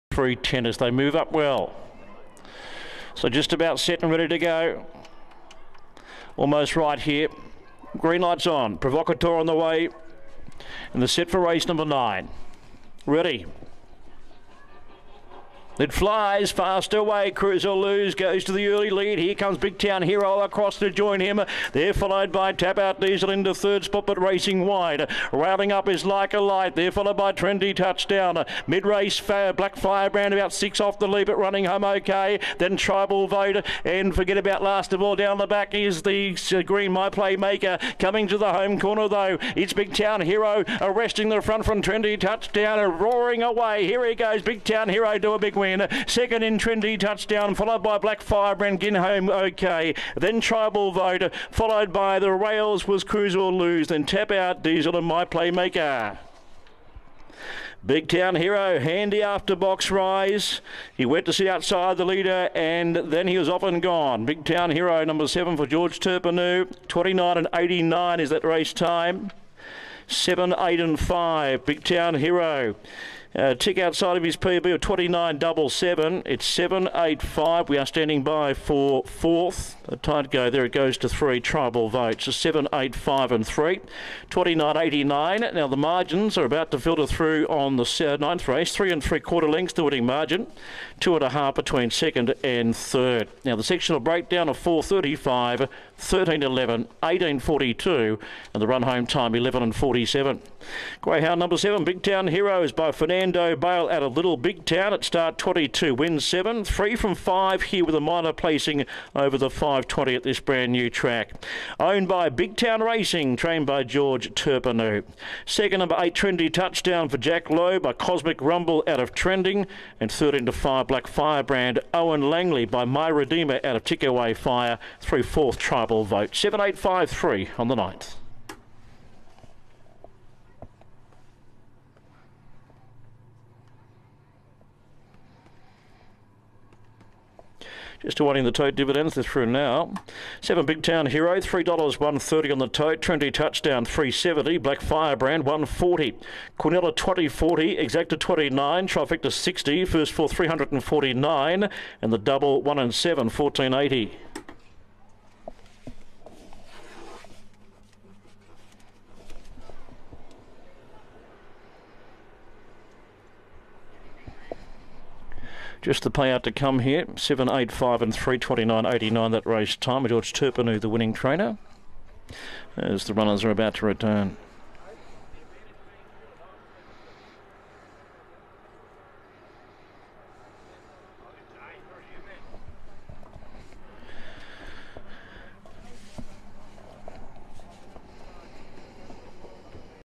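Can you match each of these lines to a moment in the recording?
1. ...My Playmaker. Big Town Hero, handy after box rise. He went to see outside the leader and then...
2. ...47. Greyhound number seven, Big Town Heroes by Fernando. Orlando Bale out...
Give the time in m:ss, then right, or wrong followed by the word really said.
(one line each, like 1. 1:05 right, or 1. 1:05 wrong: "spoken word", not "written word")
1. 0:55 right
2. 1:39 right.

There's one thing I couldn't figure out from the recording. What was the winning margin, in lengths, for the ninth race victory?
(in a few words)
3 3/4 lengths.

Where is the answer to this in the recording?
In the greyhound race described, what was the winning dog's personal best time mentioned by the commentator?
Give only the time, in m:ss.
1:14.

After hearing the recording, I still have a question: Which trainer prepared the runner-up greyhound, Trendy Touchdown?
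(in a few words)
Jack Lowe.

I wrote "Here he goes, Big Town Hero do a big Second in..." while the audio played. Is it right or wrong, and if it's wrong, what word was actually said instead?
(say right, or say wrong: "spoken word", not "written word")
right.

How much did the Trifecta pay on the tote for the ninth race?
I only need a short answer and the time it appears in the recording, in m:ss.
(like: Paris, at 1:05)
$60, at 2:28.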